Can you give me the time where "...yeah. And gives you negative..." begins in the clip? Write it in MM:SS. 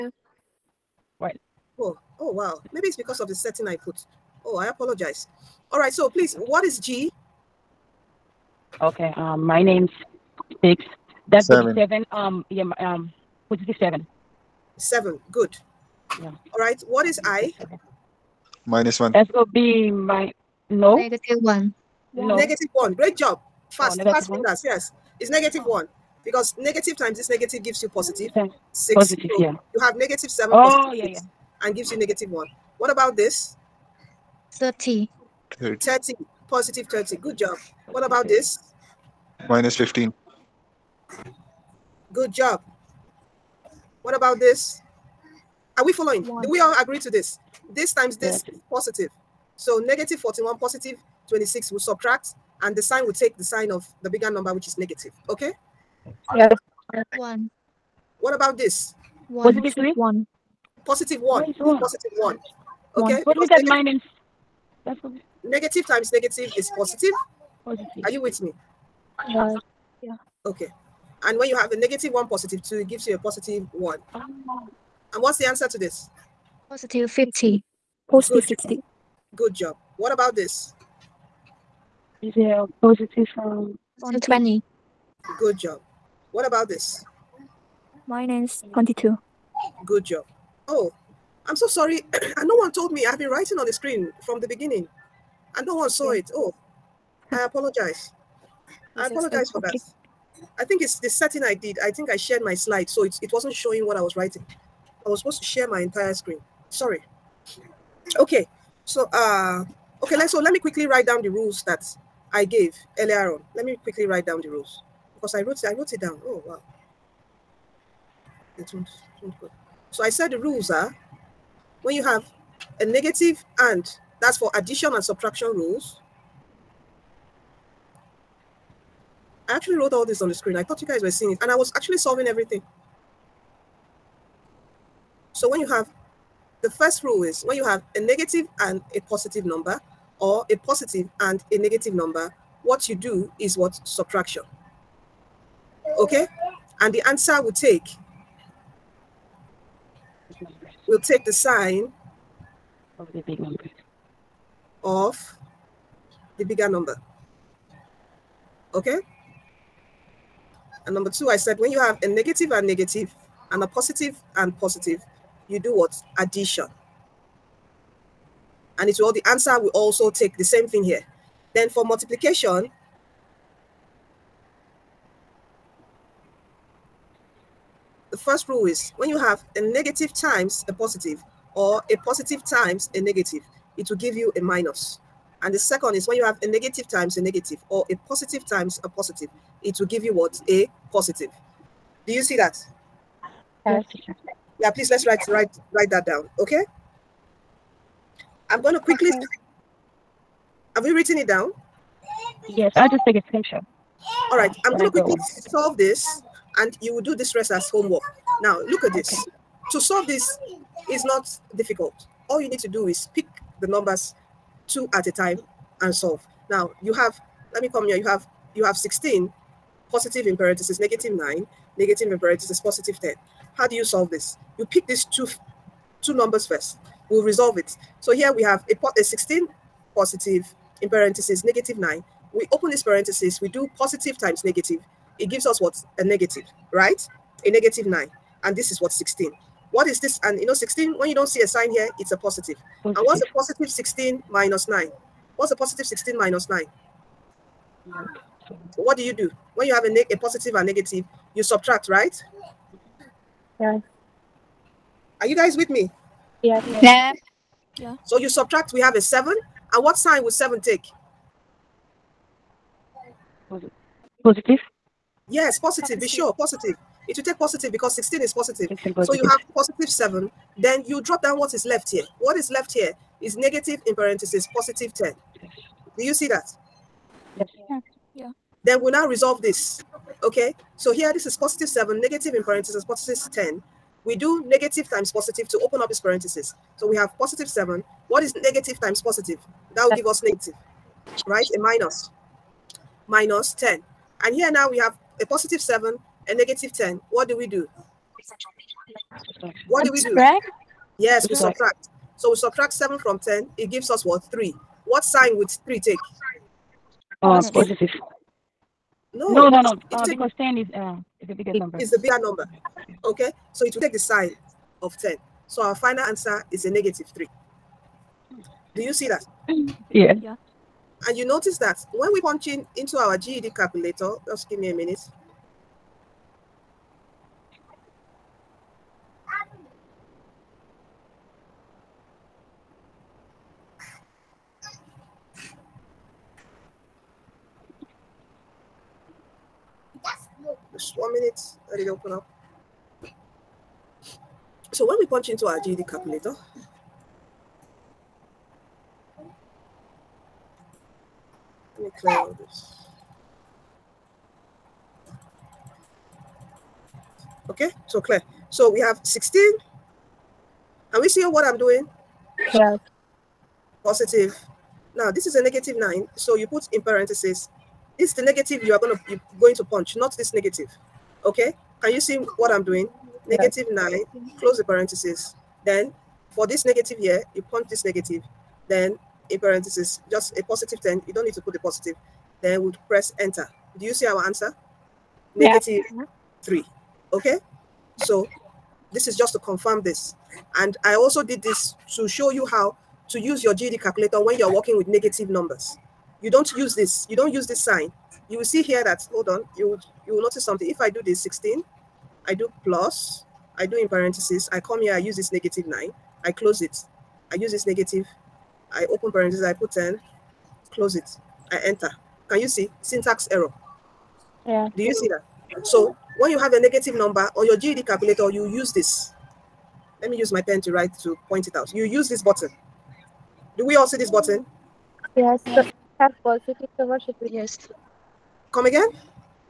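00:31.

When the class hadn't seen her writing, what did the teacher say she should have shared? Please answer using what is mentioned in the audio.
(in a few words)
entire screen.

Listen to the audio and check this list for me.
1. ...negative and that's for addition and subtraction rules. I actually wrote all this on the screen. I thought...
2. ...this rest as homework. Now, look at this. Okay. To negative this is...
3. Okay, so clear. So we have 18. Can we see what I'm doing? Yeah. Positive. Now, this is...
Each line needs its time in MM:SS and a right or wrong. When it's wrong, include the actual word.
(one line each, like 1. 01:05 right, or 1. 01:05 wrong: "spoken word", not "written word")
1. 02:02 right
2. 03:27 wrong: "solve", not "negative"
3. 05:57 wrong: "16", not "18".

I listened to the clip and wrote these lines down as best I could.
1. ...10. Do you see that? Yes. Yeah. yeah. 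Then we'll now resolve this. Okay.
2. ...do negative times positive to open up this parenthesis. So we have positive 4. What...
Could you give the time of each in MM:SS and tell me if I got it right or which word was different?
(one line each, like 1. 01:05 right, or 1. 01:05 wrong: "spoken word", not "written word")
1. 04:34 right
2. 04:44 wrong: "7", not "4".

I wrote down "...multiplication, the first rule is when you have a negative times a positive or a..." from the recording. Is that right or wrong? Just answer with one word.
right.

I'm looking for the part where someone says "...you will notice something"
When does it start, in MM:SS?
06:40.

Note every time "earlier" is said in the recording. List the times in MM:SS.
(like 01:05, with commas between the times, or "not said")
01:52.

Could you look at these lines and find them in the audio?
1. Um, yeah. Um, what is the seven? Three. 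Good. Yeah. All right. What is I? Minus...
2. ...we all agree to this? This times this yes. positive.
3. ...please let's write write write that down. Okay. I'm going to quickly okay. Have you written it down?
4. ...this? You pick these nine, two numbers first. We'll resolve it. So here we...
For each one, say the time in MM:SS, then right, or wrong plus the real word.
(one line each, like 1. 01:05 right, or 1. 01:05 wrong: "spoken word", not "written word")
1. 00:12 wrong: "Seven", not "Three"
2. 00:46 right
3. 03:14 right
4. 03:44 wrong: "two", not "nine".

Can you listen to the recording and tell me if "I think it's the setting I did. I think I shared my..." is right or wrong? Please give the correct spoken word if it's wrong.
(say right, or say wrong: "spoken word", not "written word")
right.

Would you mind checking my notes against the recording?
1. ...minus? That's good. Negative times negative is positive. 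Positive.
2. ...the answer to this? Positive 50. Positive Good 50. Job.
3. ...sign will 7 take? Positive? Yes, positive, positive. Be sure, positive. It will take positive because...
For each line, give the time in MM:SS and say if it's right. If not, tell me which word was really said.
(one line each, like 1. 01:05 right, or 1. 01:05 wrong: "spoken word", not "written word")
1. 01:03 right
2. 01:15 right
3. 04:19 right.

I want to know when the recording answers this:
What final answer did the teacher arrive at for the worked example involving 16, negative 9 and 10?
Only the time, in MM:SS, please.
05:16.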